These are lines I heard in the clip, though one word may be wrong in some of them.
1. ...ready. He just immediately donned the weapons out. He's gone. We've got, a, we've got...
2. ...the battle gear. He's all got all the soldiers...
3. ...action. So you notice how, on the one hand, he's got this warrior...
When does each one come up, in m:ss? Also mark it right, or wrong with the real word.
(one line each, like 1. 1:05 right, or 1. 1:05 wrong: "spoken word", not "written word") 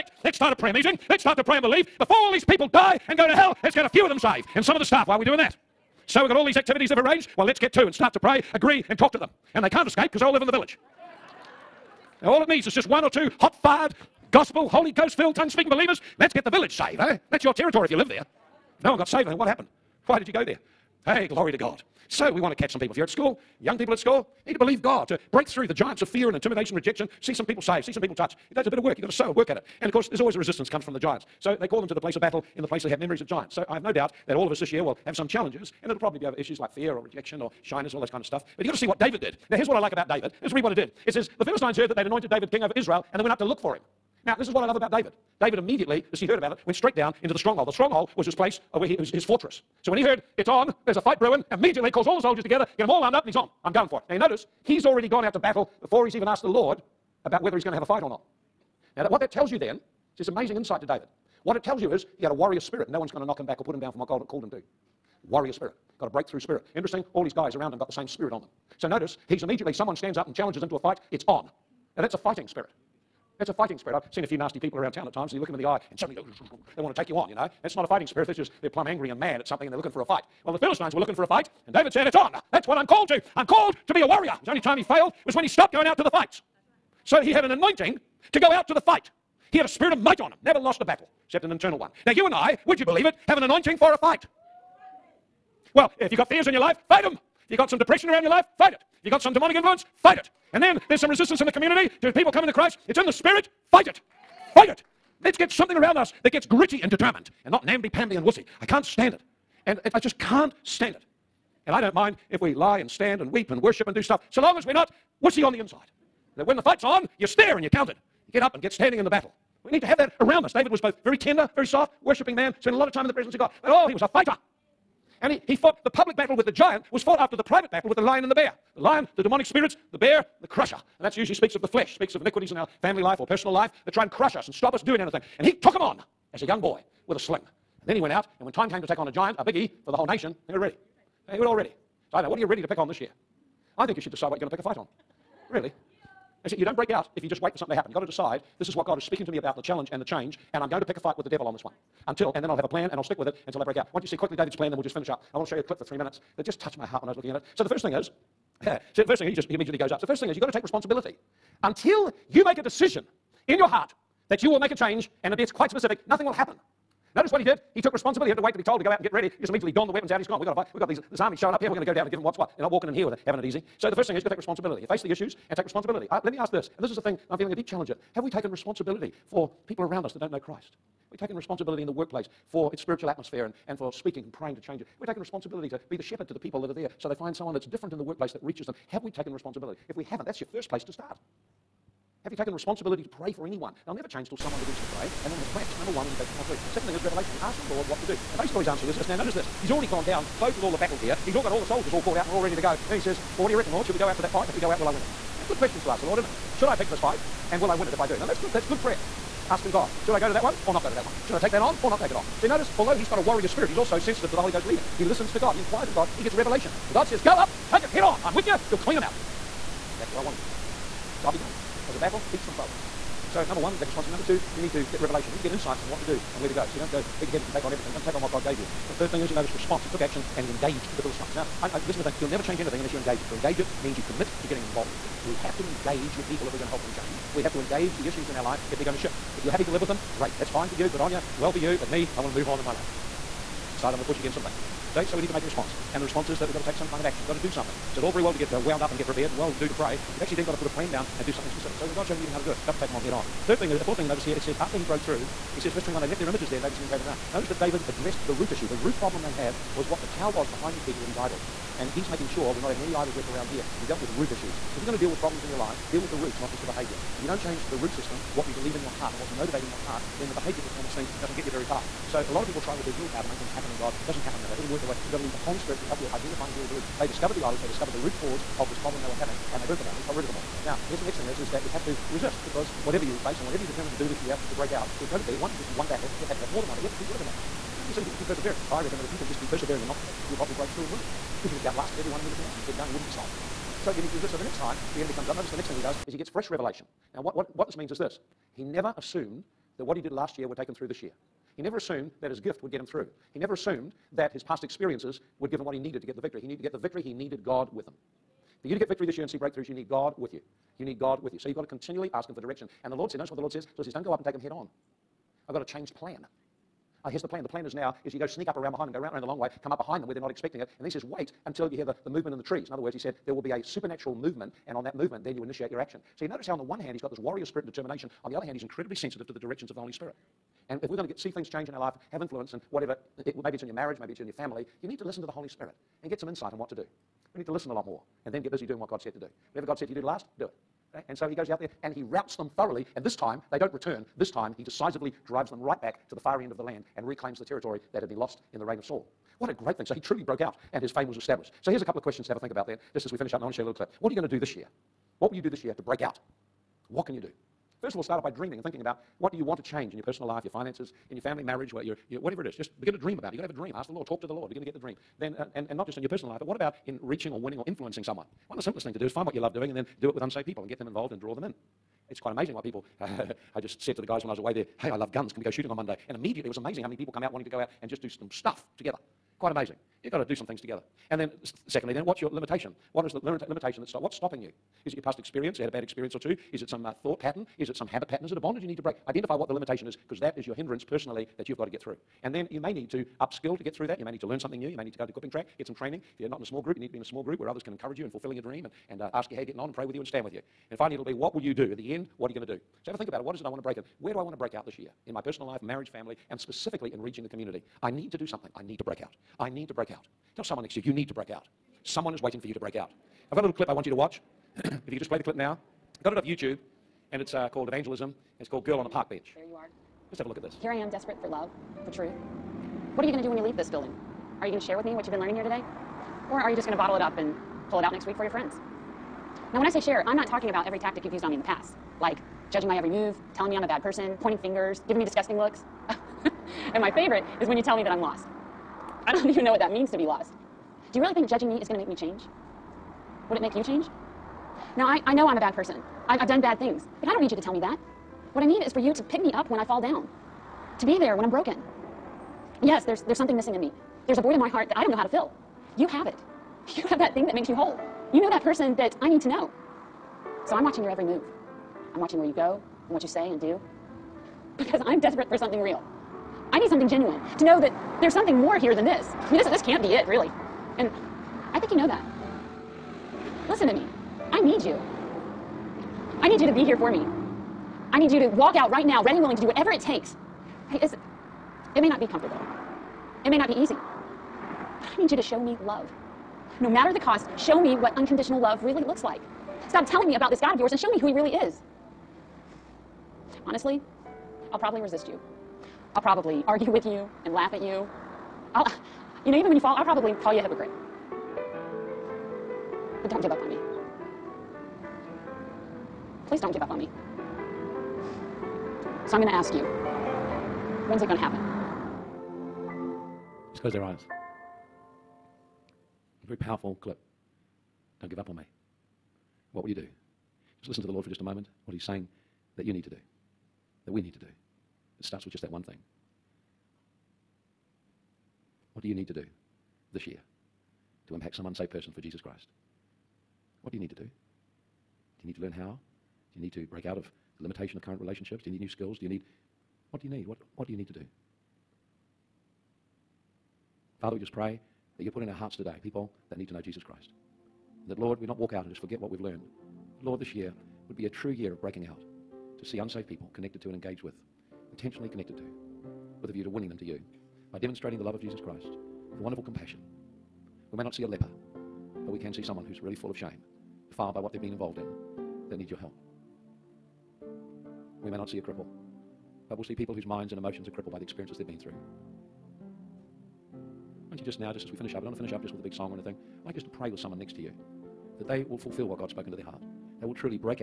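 1. 2:49 right
2. 3:20 right
3. 5:25 right.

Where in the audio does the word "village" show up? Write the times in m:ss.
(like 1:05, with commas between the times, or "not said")
0:10, 0:16.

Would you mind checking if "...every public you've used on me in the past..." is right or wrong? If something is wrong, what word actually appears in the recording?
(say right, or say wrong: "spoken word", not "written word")
wrong: "tactic", not "public".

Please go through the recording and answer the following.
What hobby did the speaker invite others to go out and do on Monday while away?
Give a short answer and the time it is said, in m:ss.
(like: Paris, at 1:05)
shooting, at 6:15.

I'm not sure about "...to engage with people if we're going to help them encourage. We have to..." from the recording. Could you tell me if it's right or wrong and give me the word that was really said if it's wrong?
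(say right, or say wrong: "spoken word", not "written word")
wrong: "change", not "encourage".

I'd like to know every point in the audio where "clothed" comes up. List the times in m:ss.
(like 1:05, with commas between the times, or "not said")
3:20.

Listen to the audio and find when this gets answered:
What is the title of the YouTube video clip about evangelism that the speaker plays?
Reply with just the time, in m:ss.
6:58.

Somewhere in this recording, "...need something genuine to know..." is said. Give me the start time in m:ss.
7:46.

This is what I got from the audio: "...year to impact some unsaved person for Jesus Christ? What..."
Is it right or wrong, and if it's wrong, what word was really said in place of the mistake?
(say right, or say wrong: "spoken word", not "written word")
right.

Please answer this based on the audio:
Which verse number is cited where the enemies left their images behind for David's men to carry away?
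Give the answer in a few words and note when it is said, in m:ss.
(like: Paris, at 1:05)
21, at 4:15.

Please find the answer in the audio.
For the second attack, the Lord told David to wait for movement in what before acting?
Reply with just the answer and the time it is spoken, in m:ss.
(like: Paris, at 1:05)
the trees, at 5:22.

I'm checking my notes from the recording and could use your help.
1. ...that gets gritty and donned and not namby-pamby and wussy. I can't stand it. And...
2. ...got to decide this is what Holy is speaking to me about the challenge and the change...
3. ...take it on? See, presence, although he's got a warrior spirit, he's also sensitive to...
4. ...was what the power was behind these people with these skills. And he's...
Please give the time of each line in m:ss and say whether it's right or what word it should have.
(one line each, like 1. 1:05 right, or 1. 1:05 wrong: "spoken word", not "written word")
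1. 1:46 wrong: "determined", not "donned"
2. 2:27 wrong: "God", not "Holy"
3. 3:31 wrong: "notice", not "presence"
4. 4:19 wrong: "idols", not "skills".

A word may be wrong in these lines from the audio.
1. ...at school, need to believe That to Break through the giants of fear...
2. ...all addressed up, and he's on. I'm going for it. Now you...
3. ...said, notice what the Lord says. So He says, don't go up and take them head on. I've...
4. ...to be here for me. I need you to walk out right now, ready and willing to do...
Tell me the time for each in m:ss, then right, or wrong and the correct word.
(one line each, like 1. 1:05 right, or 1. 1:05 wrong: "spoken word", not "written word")
1. 0:23 wrong: "God", not "That"
2. 0:52 wrong: "armed", not "addressed"
3. 5:13 right
4. 7:56 right.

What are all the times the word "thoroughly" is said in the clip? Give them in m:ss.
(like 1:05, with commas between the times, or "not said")
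3:42, 5:42.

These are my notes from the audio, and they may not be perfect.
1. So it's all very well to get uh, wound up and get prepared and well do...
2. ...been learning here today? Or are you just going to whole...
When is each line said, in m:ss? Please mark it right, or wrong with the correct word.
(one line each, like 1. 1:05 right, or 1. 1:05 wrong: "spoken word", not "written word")
1. 4:07 right
2. 7:05 wrong: "bottle", not "whole".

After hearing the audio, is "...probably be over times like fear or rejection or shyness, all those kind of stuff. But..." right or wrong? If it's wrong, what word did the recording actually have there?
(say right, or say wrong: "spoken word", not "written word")
wrong: "issues", not "times".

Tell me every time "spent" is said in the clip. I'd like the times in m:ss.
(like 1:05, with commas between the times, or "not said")
2:02.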